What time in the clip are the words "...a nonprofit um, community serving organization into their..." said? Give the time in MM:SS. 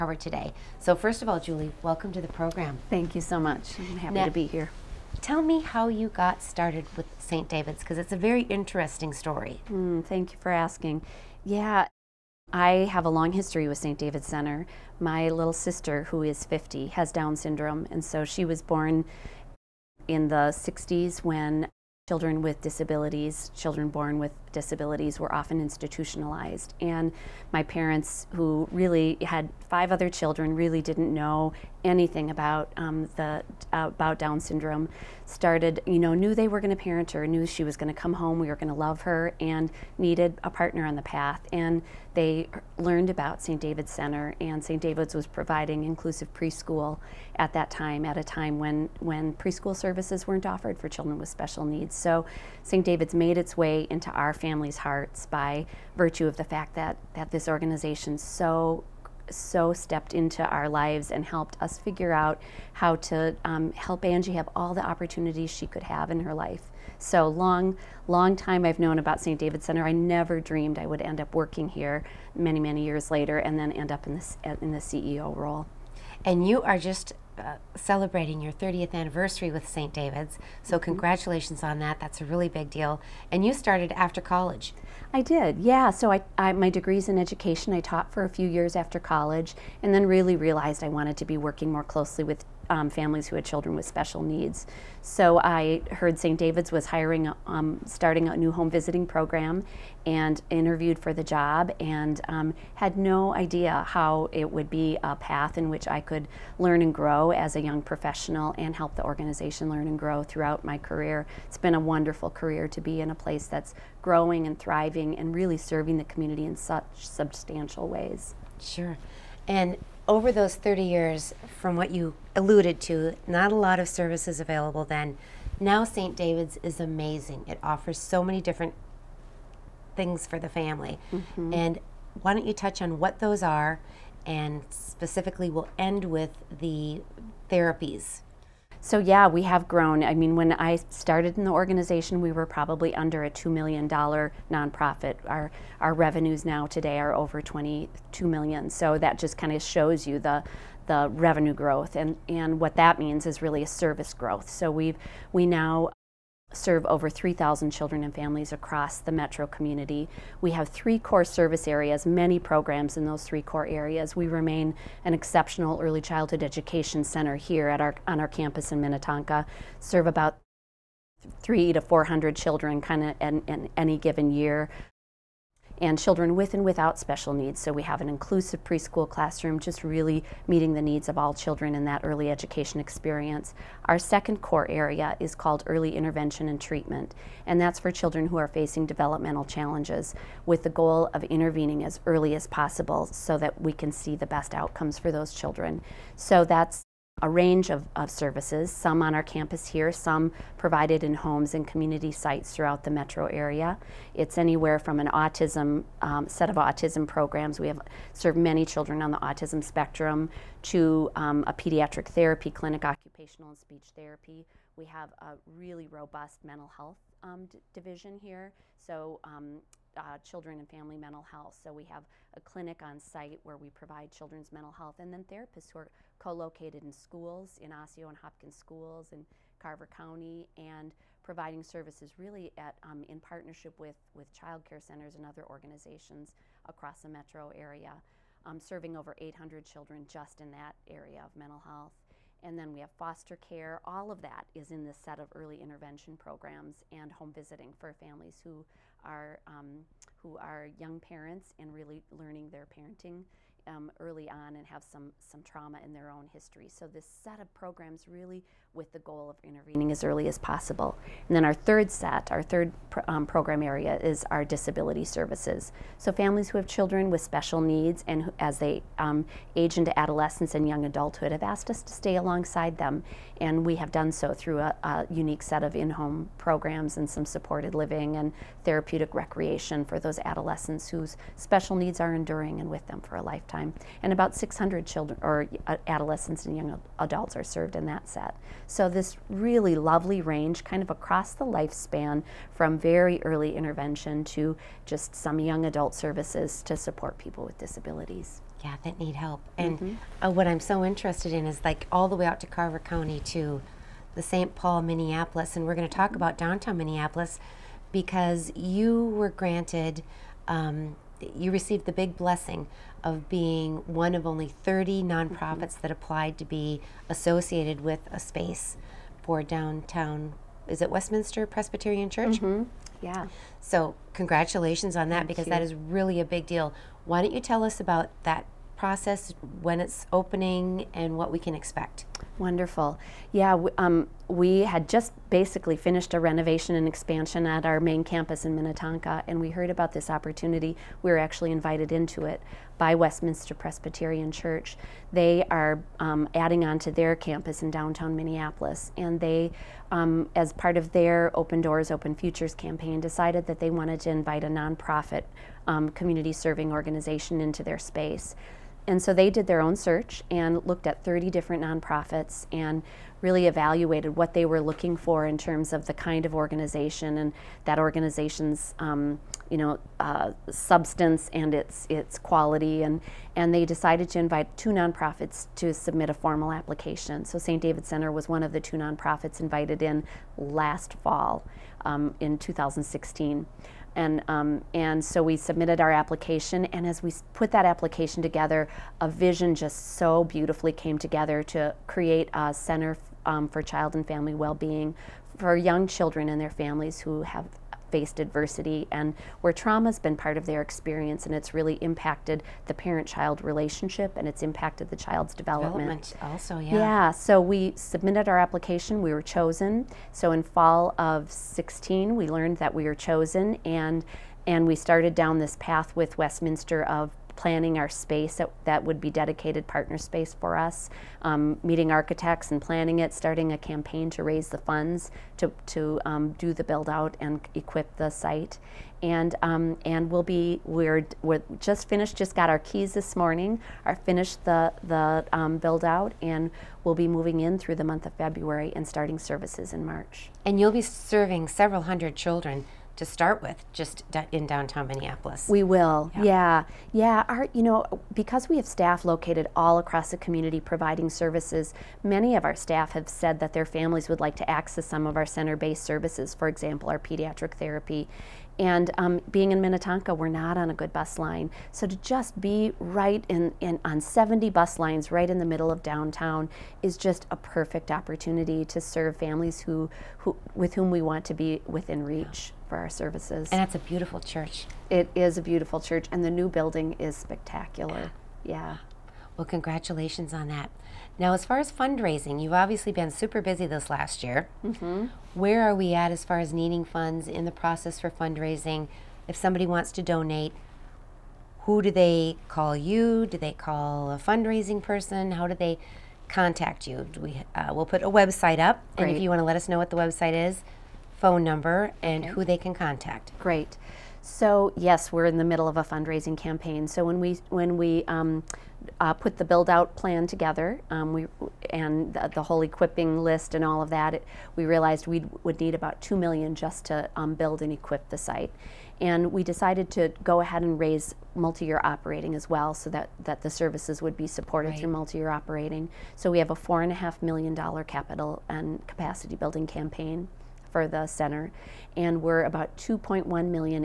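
05:54.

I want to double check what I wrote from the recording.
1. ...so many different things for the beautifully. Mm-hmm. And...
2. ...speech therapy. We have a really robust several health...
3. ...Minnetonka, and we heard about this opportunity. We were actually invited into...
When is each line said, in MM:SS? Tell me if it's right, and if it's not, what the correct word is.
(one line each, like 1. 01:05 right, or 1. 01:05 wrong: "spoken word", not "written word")
1. 02:07 wrong: "family", not "beautifully"
2. 03:33 wrong: "mental", not "several"
3. 05:38 right.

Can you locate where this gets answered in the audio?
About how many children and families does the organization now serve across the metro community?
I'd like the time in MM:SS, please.
02:37.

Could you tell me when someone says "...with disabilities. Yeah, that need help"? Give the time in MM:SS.
04:57.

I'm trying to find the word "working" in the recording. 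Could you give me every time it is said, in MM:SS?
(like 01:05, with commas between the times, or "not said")
01:11, 01:31.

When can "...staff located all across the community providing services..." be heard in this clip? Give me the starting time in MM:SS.
07:28.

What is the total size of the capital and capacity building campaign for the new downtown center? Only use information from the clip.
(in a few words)
$4.5 million.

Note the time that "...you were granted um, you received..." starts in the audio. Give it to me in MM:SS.
05:08.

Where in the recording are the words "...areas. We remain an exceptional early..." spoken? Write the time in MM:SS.
02:43.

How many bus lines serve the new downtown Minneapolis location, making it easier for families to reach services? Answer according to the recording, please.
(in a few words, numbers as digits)
70.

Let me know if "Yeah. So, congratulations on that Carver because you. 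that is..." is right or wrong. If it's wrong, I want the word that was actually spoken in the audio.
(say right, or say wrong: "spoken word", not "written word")
wrong: "Thank", not "Carver".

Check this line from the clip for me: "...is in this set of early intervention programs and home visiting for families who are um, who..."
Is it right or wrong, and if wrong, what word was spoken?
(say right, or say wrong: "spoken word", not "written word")
right.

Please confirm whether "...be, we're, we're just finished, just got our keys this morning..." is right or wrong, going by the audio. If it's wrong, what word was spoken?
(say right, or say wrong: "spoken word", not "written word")
right.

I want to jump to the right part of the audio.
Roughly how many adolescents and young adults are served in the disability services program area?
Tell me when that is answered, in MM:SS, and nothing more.
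04:44.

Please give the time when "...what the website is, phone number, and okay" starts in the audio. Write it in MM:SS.
08:19.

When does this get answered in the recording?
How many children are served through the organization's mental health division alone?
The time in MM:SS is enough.
03:58.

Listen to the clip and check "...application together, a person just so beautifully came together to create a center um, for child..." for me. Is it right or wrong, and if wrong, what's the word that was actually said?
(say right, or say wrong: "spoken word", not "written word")
wrong: "vision", not "person".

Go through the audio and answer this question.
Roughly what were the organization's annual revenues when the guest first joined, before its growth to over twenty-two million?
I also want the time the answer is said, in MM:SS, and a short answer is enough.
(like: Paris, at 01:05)
under $2 million, at 02:22.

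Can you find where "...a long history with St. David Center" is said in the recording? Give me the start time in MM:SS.
00:13.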